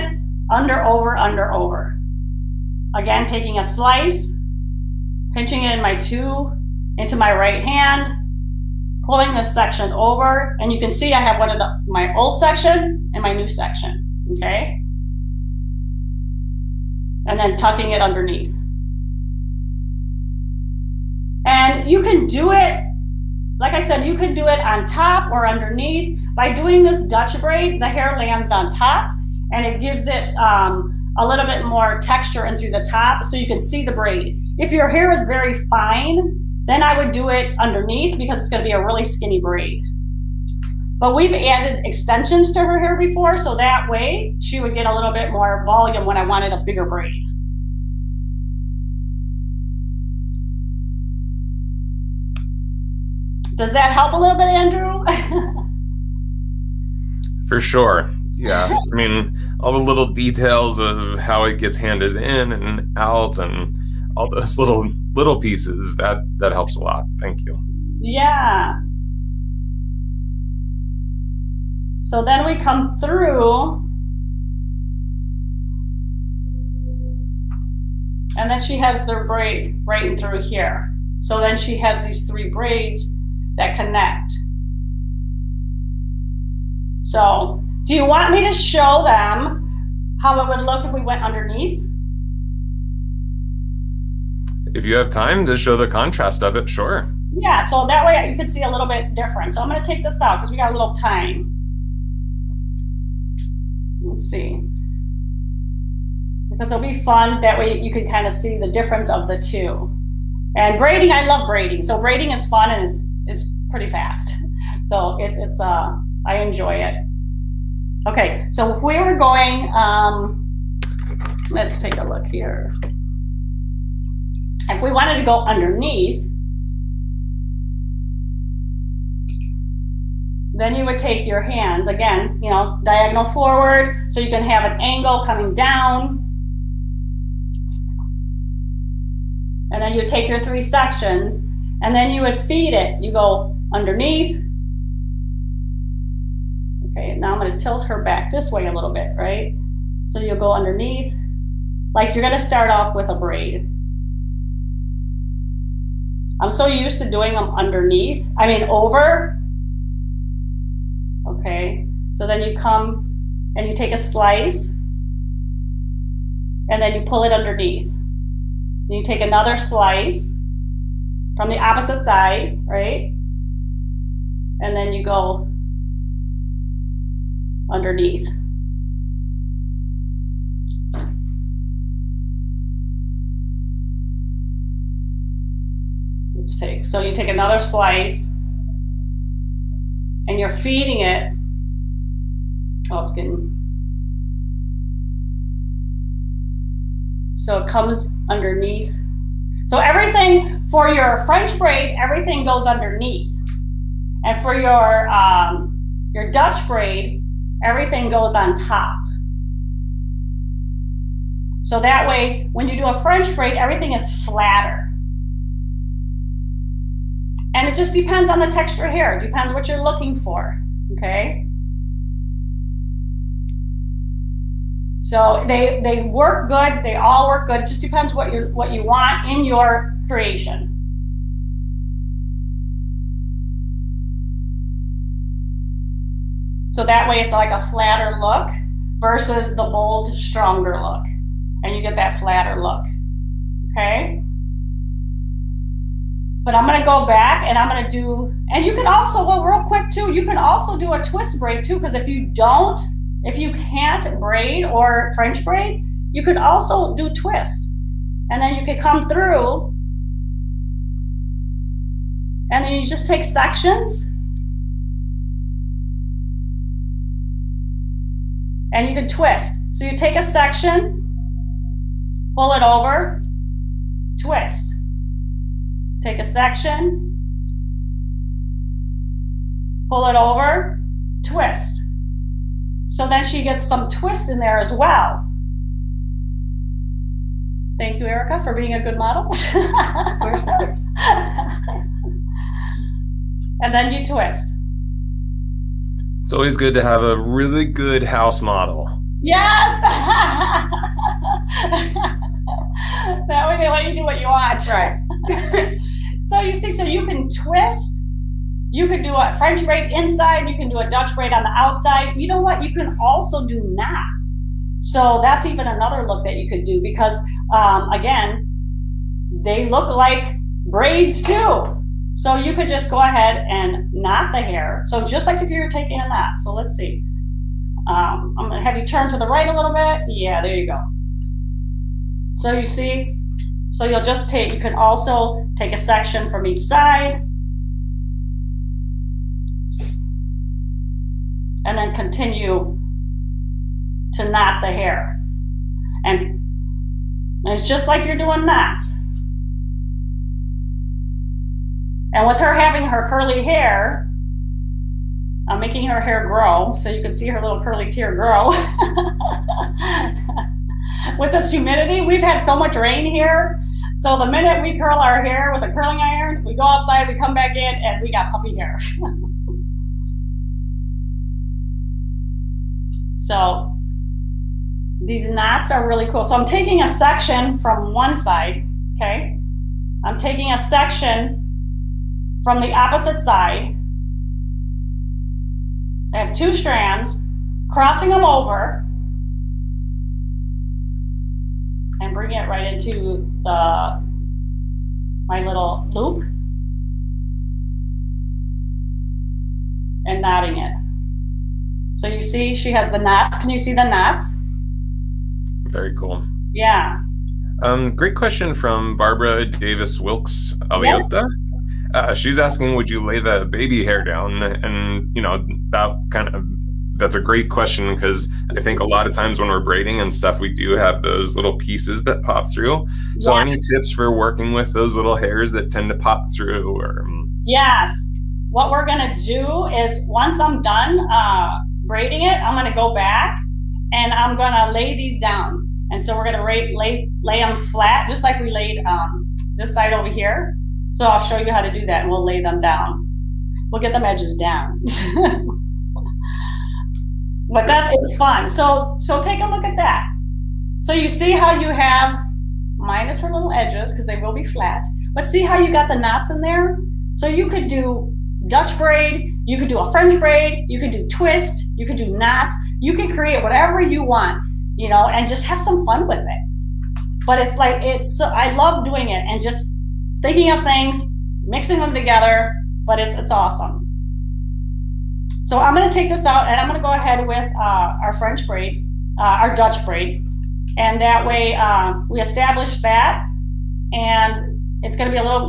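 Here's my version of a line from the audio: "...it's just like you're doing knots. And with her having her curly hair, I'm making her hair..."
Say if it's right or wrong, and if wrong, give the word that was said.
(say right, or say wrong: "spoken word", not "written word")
right.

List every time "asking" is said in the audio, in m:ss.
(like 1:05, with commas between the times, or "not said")
6:52.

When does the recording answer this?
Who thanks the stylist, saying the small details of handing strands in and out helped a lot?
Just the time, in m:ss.
0:54.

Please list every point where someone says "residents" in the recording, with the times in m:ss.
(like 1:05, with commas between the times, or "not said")
not said.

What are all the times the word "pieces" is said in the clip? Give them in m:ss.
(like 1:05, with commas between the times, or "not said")
1:05, 7:01.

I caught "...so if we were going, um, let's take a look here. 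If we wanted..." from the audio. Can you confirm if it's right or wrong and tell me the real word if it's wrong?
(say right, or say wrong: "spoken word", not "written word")
right.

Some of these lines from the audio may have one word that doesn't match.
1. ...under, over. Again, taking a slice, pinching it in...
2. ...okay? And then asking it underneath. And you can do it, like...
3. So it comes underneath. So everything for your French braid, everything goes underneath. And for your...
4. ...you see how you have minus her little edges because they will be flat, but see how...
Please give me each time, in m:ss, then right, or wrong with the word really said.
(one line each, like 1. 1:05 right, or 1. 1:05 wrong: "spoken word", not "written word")
1. 0:01 right
2. 0:14 wrong: "tucking", not "asking"
3. 3:17 right
4. 7:30 right.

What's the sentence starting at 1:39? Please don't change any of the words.
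So I'm going to take this out because we got a little time.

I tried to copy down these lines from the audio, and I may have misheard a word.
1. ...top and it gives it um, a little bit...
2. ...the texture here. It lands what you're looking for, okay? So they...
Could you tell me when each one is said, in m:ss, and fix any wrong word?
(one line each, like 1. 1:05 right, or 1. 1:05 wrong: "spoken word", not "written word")
1. 0:28 right
2. 3:38 wrong: "depends", not "lands".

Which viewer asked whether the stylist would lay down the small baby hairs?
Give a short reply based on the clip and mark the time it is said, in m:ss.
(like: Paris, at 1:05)
Barbara Davis Wilkes Aliota, at 6:48.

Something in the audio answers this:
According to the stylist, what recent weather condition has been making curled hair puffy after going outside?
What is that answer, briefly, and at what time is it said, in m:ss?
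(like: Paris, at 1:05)
Rain, at 6:02.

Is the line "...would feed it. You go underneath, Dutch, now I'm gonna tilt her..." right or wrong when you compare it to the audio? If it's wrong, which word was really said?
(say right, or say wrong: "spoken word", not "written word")
wrong: "Okay", not "Dutch".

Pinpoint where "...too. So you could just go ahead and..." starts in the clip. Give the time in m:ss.
5:21.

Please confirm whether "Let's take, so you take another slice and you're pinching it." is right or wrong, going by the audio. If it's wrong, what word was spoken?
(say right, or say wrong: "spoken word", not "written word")
wrong: "feeding", not "pinching".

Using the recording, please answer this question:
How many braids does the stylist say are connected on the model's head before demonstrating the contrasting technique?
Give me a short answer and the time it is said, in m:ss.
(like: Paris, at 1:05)
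3, at 1:22.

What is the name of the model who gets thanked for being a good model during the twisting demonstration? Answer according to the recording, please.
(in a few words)
Erica.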